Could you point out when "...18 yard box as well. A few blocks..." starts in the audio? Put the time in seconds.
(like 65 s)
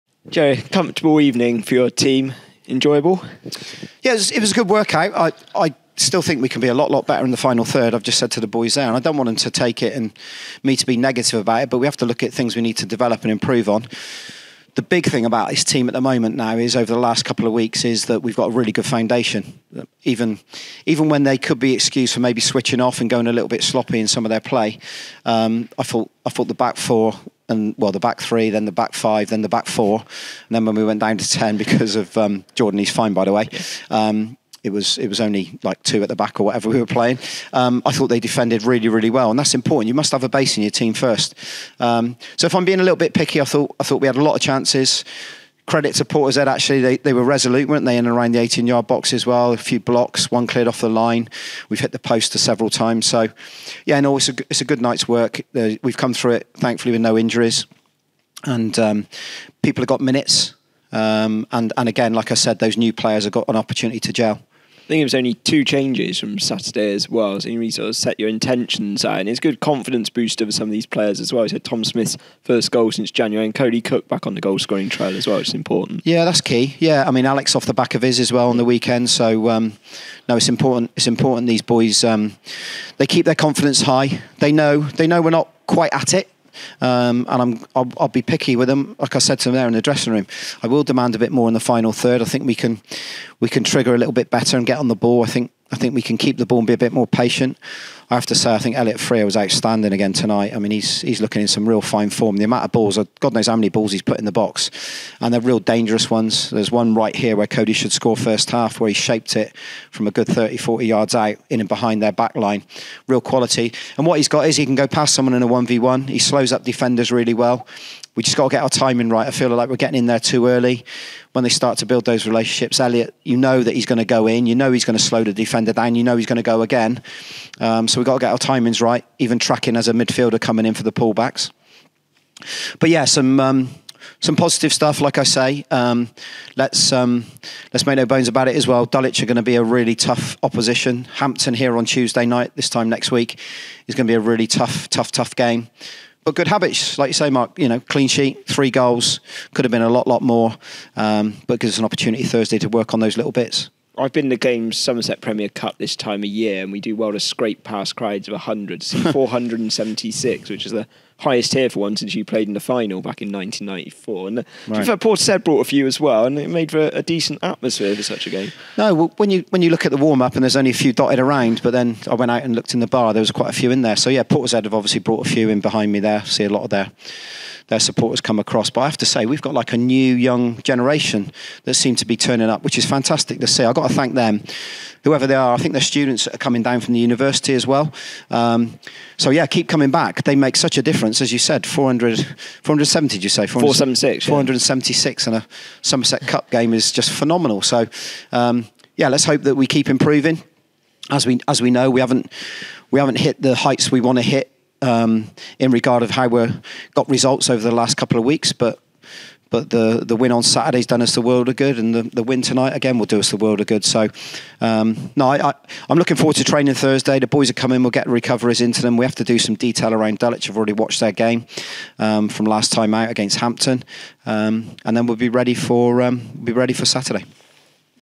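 48 s.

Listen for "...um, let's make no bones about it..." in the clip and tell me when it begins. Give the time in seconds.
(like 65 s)
136 s.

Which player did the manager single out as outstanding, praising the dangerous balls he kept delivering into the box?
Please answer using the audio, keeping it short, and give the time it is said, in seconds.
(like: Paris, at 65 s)
Elliot Freer, at 98 s.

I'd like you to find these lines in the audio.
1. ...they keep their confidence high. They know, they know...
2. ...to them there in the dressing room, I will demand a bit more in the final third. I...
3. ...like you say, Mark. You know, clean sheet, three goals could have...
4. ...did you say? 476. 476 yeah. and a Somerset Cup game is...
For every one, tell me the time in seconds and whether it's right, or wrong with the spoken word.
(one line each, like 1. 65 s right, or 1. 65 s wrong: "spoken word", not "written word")
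1. 82 s right
2. 89 s right
3. 146 s right
4. 193 s right.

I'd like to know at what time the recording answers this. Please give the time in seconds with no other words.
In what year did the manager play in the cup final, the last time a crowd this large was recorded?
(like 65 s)
163 s.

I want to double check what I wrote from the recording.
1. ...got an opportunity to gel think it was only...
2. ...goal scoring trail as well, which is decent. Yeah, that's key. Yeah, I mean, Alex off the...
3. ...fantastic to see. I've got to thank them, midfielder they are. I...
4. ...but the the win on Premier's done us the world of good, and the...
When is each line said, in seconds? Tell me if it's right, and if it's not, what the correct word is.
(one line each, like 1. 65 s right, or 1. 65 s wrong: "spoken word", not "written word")
1. 63 s right
2. 74 s wrong: "important", not "decent"
3. 182 s wrong: "whoever", not "midfielder"
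4. 209 s wrong: "Saturday", not "Premier".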